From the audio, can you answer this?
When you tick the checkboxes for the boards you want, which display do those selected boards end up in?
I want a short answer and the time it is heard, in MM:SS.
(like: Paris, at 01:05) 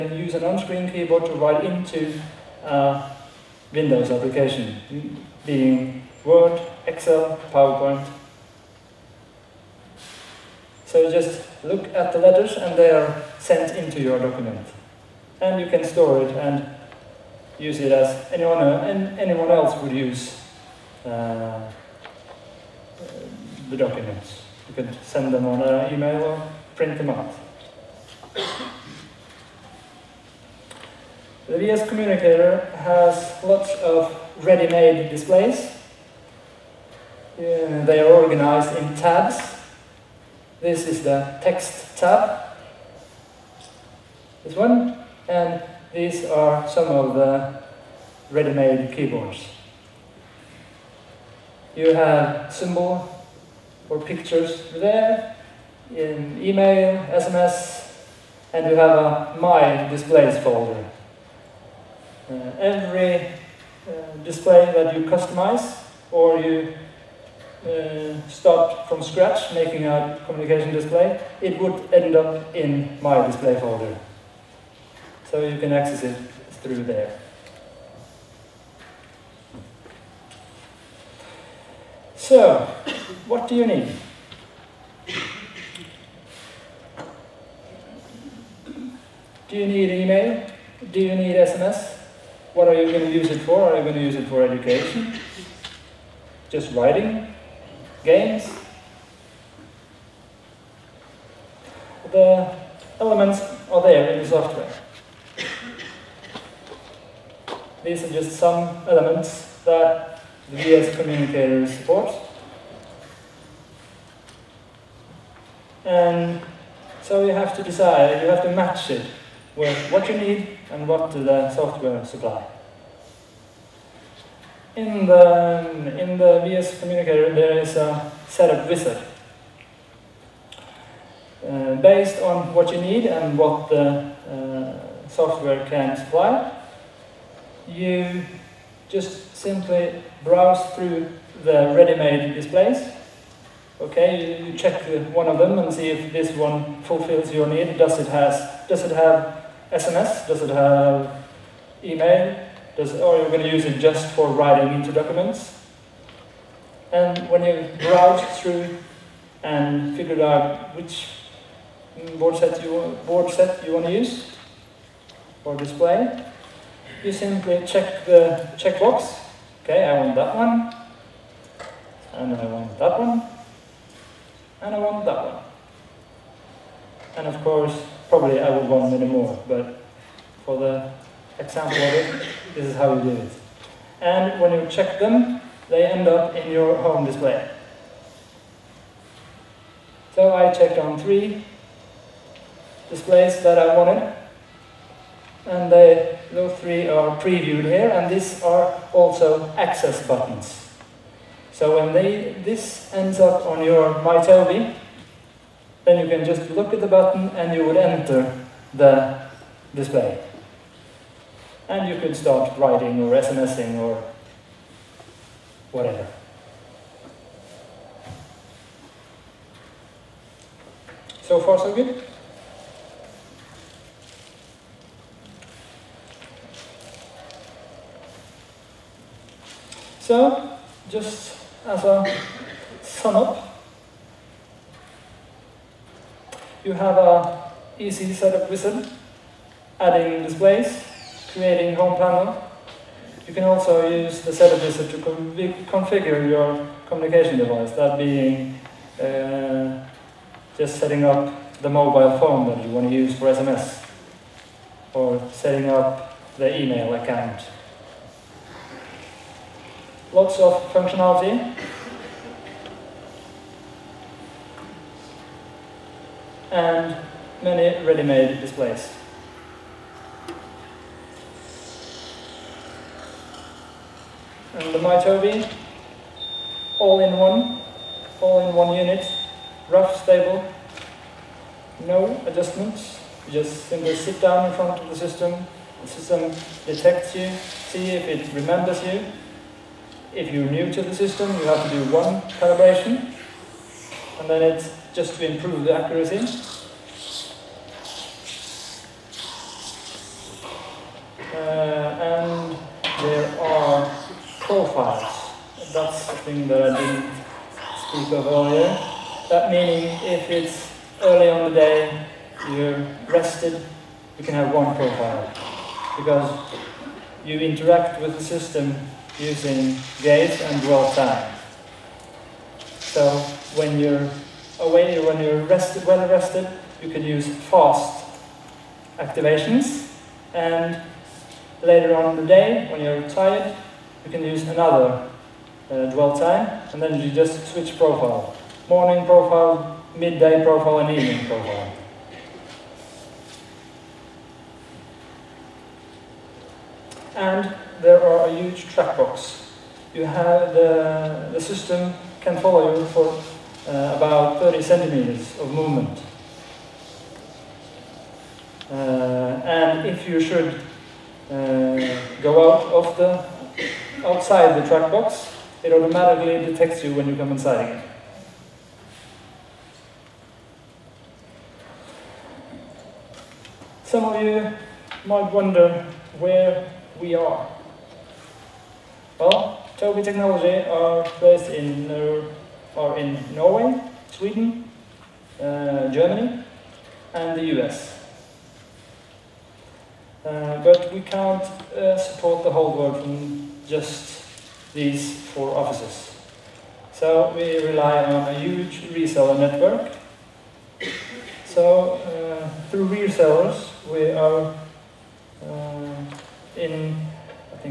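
home display, at 03:06.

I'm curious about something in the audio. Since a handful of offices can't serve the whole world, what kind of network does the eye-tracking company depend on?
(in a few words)
reseller network.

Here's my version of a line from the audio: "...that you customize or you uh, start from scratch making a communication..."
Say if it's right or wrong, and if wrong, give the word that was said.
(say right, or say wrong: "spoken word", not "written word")
right.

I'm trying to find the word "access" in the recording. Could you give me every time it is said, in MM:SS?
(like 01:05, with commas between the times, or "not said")
01:15, 03:19.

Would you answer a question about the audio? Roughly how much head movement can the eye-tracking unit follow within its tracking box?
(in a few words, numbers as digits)
30 centimeters.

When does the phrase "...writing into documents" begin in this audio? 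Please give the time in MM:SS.
02:34.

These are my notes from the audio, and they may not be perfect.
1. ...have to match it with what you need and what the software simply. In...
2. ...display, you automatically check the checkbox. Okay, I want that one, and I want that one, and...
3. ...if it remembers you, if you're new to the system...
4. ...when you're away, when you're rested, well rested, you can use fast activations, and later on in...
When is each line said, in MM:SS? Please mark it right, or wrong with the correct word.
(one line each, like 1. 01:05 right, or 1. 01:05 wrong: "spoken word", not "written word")
1. 01:58 wrong: "supply", not "simply"
2. 02:45 wrong: "simply", not "automatically"
3. 04:47 right
4. 05:23 right.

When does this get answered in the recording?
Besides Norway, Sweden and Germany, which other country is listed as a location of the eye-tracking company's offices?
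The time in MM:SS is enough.
06:27.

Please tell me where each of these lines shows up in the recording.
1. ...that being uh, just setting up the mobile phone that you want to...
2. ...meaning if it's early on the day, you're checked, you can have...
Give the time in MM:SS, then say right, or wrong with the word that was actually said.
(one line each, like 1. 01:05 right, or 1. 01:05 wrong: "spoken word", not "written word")
1. 04:07 right
2. 05:09 wrong: "rested", not "checked".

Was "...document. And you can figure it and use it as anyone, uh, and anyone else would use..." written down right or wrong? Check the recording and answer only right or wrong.
wrong.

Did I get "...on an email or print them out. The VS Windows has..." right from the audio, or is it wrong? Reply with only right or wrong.
wrong.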